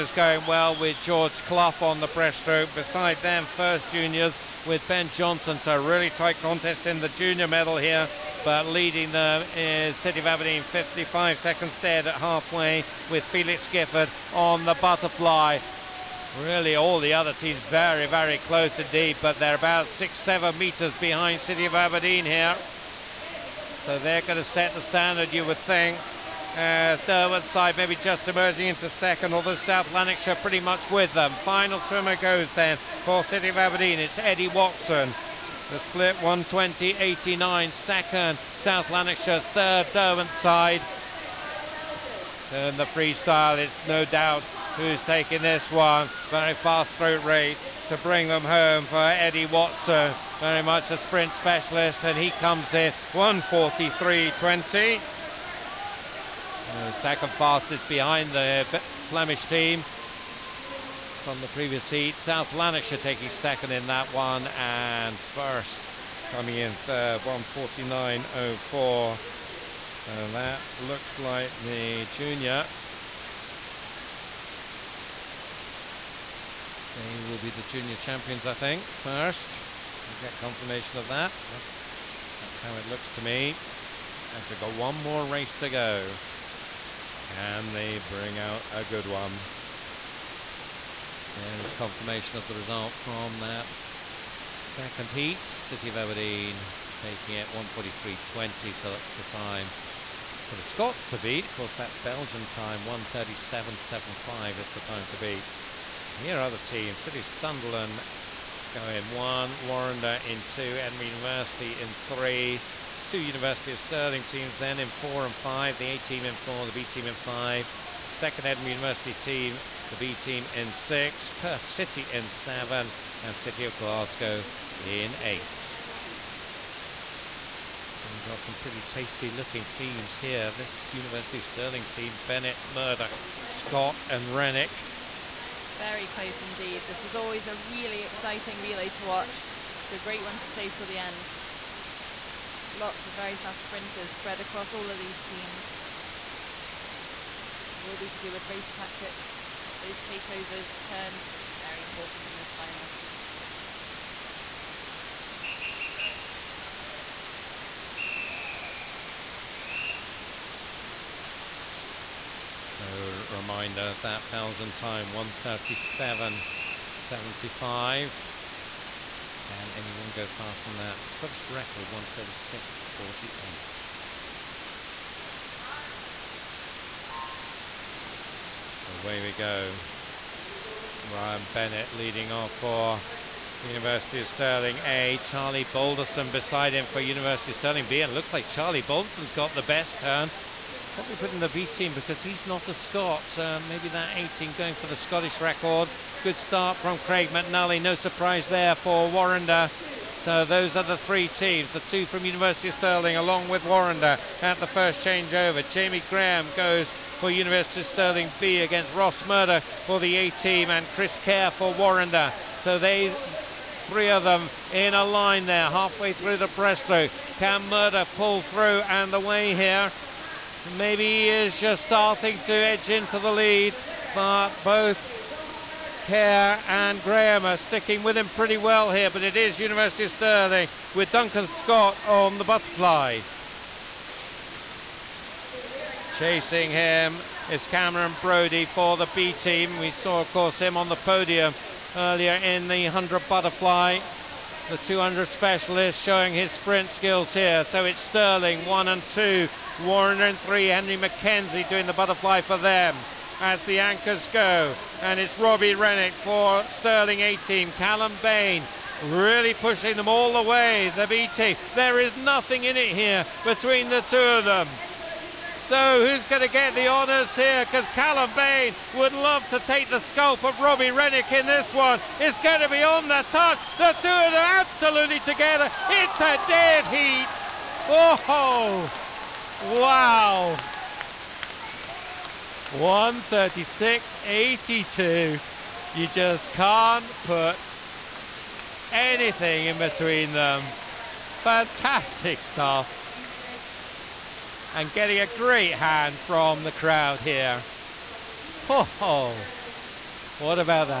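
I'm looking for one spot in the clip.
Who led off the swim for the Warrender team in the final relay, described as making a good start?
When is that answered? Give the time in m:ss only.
3:16.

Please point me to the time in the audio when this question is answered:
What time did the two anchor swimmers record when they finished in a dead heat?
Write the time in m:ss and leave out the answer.
4:42.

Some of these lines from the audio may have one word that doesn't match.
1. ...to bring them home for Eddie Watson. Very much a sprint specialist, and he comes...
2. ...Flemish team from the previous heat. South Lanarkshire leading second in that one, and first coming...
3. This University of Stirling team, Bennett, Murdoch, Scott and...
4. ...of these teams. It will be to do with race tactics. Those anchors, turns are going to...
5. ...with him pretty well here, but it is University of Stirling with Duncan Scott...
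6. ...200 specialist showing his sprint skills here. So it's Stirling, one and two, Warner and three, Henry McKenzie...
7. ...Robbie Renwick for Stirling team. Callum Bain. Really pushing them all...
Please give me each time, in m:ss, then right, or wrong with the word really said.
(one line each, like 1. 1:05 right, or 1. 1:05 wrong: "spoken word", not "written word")
1. 0:47 right
2. 0:59 wrong: "taking", not "leading"
3. 2:10 right
4. 2:24 wrong: "takeovers", not "anchors"
5. 3:48 right
6. 4:04 right
7. 4:15 right.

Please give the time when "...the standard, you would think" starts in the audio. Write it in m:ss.
0:24.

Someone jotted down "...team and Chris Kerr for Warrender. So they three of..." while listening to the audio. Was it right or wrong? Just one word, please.
right.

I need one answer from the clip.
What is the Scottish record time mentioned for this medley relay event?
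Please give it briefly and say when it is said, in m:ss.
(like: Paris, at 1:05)
1:36.48, at 2:51.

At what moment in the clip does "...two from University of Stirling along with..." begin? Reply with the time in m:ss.
3:21.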